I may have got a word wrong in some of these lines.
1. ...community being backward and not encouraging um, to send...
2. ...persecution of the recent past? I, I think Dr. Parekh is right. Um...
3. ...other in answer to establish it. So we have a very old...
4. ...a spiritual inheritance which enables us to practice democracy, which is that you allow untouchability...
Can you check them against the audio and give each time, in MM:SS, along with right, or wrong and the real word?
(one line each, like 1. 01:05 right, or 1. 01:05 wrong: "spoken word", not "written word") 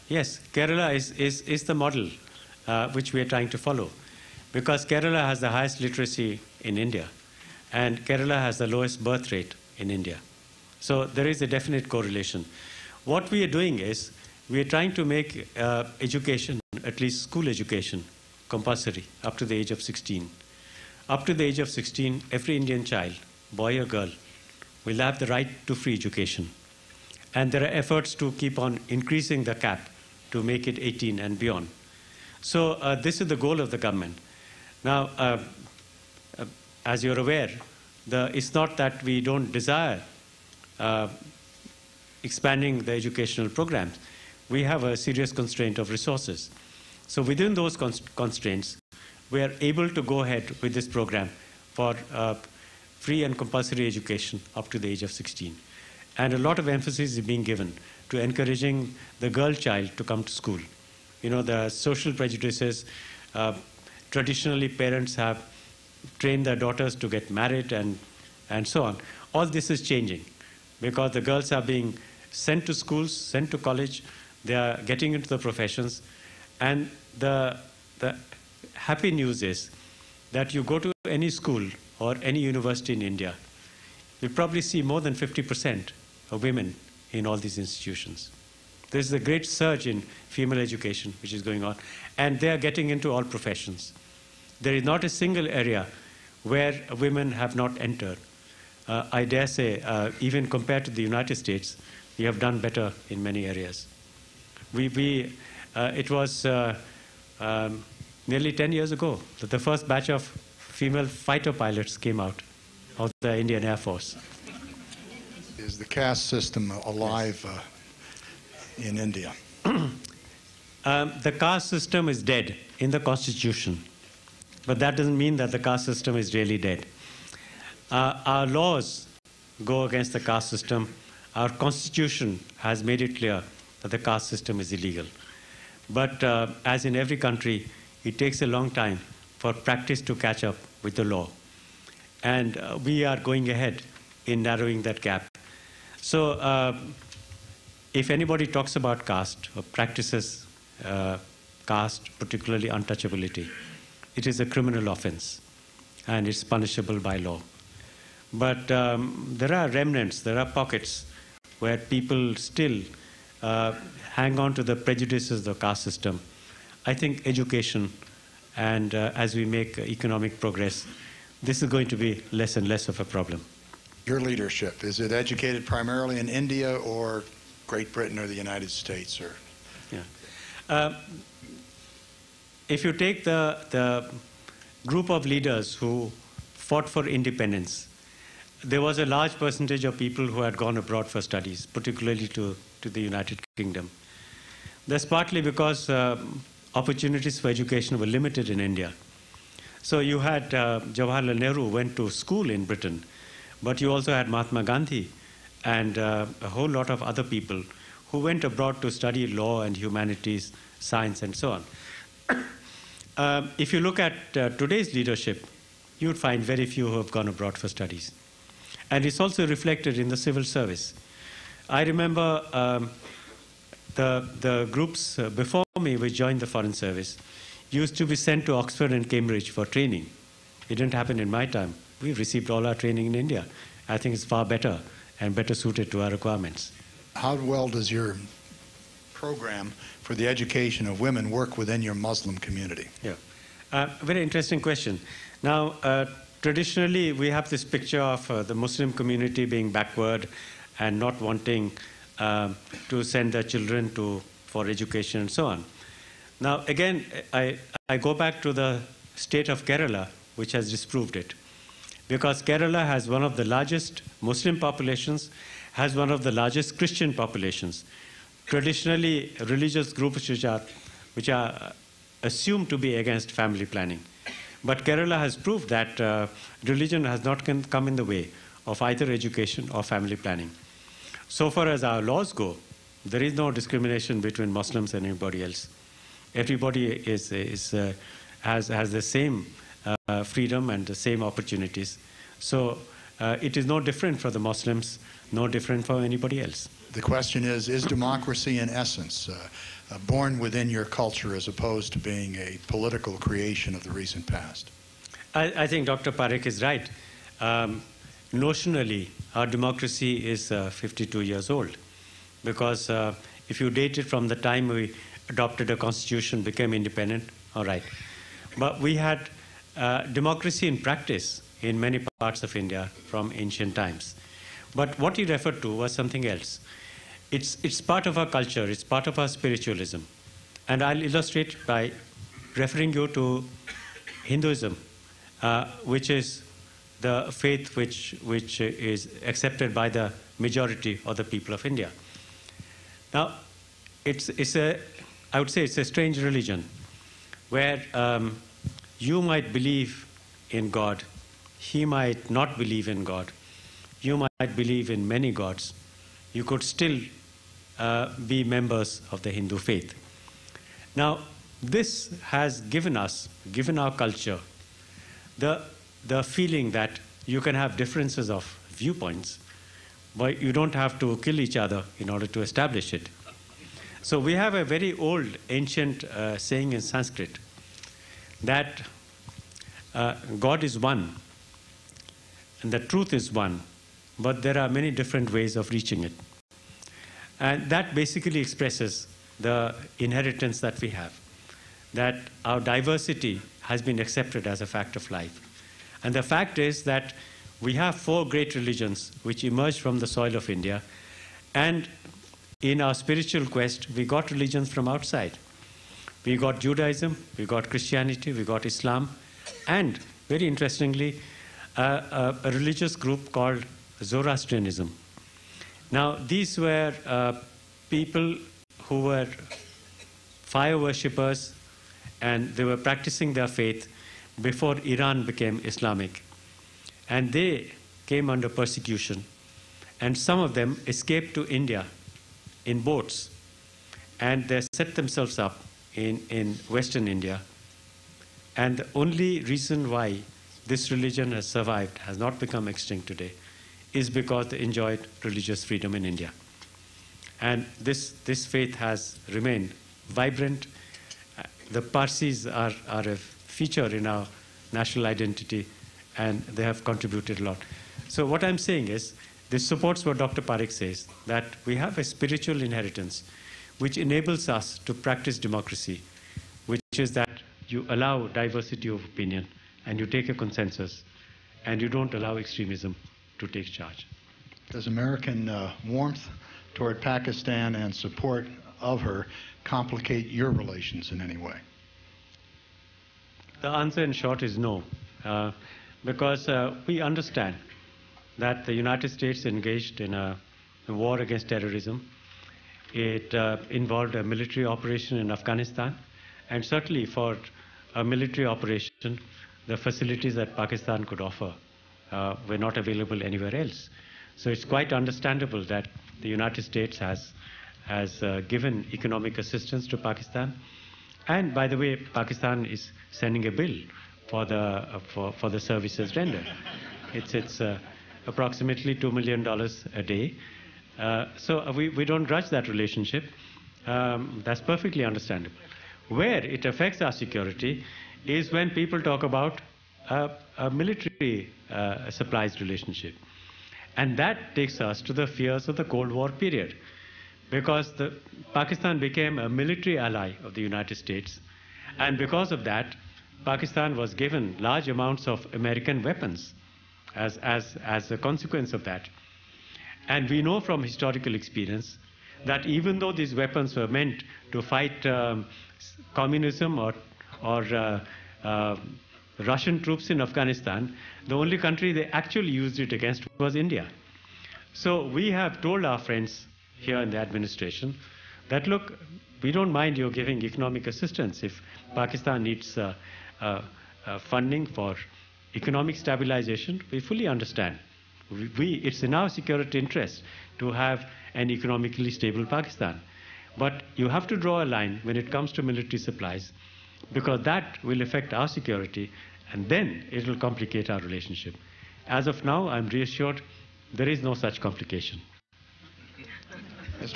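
1. 04:08 wrong: "wanting", not "encouraging"
2. 05:03 wrong: "creation", not "persecution"
3. 06:11 wrong: "order", not "answer"
4. 07:41 wrong: "diversity", not "untouchability".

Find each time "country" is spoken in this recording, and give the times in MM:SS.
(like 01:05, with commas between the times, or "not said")
02:17, 09:21.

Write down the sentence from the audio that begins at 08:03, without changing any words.
The answer in short is no, uh, because uh, we understand that the United States engaged in a, a war against terrorism.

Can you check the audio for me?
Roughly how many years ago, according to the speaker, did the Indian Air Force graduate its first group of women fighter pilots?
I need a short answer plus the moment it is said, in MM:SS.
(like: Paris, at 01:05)
10 years, at 01:48.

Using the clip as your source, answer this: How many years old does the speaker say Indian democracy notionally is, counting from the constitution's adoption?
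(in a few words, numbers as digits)
52.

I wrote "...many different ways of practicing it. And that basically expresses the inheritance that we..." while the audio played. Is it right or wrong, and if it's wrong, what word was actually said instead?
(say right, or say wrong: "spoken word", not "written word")
wrong: "reaching", not "practicing".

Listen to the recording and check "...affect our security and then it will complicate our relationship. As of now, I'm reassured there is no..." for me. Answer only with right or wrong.
right.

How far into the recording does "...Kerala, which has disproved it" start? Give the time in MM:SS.
04:19.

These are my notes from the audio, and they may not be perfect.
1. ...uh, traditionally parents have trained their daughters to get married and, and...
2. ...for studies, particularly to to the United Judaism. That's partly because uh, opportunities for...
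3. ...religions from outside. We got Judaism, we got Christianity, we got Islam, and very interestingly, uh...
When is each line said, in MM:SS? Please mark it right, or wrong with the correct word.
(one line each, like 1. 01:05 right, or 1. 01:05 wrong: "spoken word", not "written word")
1. 01:03 right
2. 03:11 wrong: "Kingdom", not "Judaism"
3. 06:44 right.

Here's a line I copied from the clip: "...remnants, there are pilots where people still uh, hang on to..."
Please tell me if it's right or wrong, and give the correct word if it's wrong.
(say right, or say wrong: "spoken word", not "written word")
wrong: "pockets", not "pilots".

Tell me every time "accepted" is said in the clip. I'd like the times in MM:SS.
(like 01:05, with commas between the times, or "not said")
05:39, 06:33.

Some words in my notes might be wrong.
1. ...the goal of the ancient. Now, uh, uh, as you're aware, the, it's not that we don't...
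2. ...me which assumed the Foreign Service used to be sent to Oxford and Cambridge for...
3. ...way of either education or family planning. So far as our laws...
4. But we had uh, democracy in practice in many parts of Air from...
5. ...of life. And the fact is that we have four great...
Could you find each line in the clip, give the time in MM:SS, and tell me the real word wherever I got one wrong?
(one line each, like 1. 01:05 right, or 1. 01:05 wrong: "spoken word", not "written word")
1. 00:33 wrong: "government", not "ancient"
2. 03:45 wrong: "joined", not "assumed"
3. 04:38 right
4. 05:18 wrong: "India", not "Air"
5. 06:34 right.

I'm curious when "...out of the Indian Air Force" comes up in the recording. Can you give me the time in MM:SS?
01:52.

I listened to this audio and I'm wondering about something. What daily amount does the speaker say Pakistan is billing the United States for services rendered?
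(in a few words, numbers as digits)
$2 million.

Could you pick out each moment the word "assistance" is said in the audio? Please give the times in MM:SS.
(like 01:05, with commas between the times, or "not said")
08:29, 09:30.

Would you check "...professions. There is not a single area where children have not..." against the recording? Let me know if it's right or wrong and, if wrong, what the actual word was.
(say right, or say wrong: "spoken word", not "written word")
wrong: "women", not "children".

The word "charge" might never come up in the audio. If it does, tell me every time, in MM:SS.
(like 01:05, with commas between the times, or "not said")
07:53.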